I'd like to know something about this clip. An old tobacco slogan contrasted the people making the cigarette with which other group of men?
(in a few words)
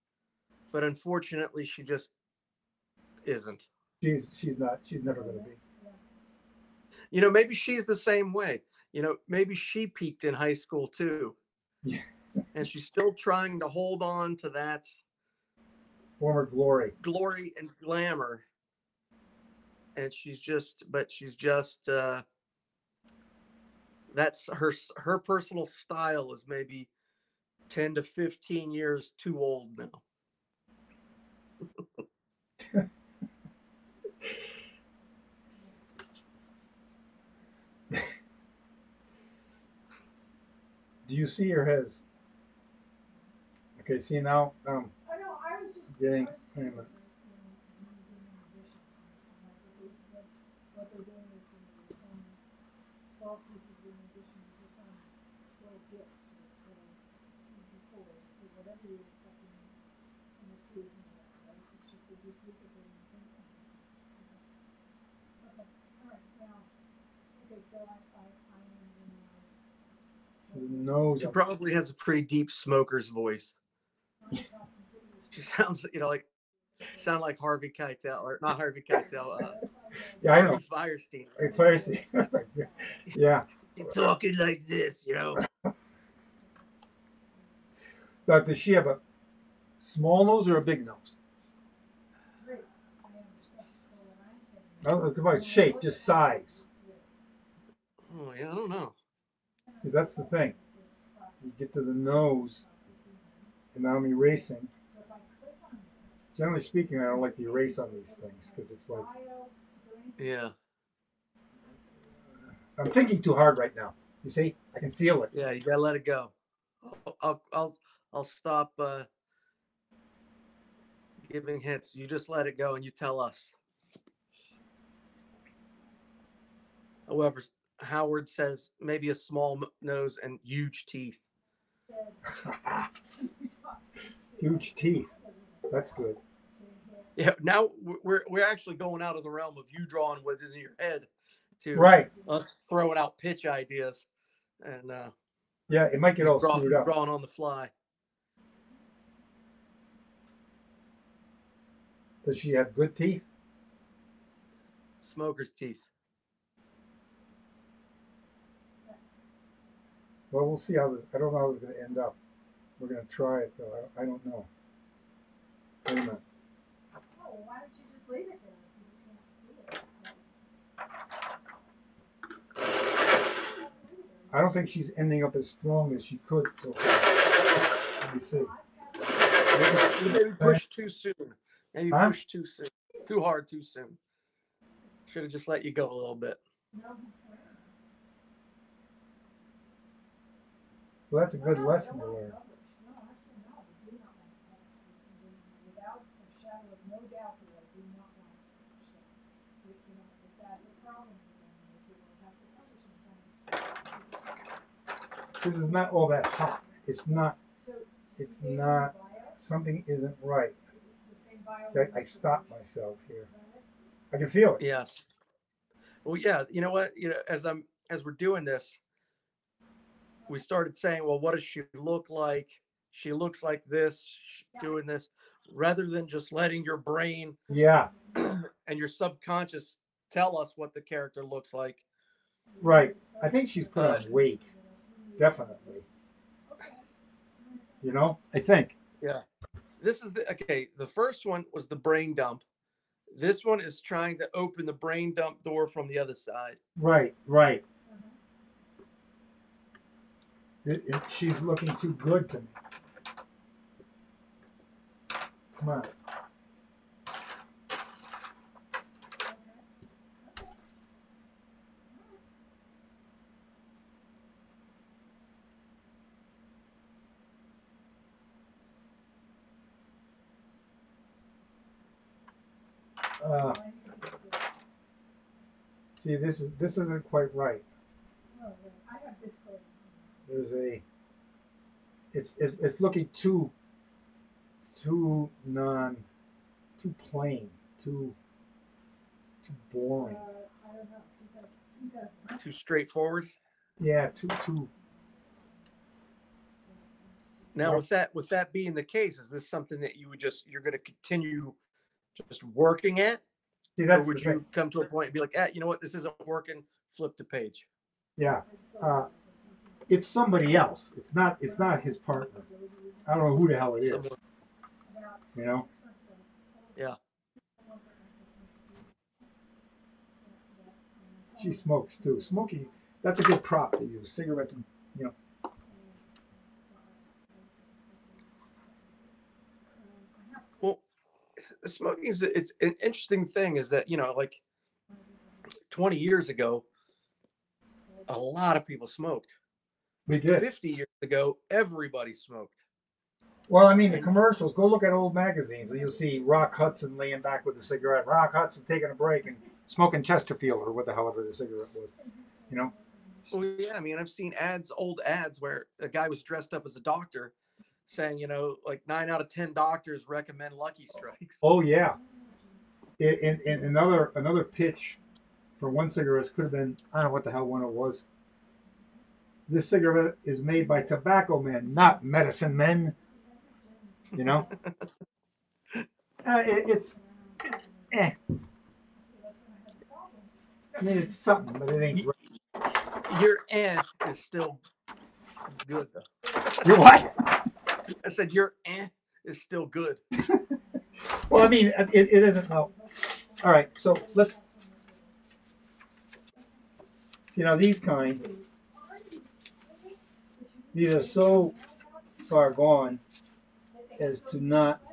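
medicine men.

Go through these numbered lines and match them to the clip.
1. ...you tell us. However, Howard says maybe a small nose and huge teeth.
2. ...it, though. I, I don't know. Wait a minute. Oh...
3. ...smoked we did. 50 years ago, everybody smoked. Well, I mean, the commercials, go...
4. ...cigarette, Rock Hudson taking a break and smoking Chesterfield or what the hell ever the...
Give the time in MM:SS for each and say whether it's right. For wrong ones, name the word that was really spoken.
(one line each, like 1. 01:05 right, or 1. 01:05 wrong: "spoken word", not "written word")
1. 02:02 right
2. 02:43 right
3. 05:38 right
4. 05:47 right.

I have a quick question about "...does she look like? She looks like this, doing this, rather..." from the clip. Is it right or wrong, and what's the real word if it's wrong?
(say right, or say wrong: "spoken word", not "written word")
right.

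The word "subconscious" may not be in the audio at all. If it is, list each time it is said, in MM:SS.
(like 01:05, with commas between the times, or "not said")
03:48.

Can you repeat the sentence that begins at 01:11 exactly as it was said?
She probably has a pretty deep smoker's voice.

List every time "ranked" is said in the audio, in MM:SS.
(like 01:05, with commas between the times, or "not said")
not said.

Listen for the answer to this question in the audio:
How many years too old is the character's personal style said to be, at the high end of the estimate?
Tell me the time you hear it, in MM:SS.
00:28.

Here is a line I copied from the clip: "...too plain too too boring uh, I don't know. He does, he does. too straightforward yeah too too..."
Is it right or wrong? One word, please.
right.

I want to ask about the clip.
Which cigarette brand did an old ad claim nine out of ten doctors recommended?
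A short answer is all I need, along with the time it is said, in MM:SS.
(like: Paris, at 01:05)
Lucky Strikes, at 06:00.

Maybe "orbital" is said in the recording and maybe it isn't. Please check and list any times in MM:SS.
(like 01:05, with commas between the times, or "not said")
not said.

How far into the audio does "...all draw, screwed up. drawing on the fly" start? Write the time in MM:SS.
02:26.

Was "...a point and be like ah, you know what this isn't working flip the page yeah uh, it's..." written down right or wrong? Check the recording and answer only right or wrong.
right.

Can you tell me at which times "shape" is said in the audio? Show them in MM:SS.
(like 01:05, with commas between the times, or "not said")
01:35.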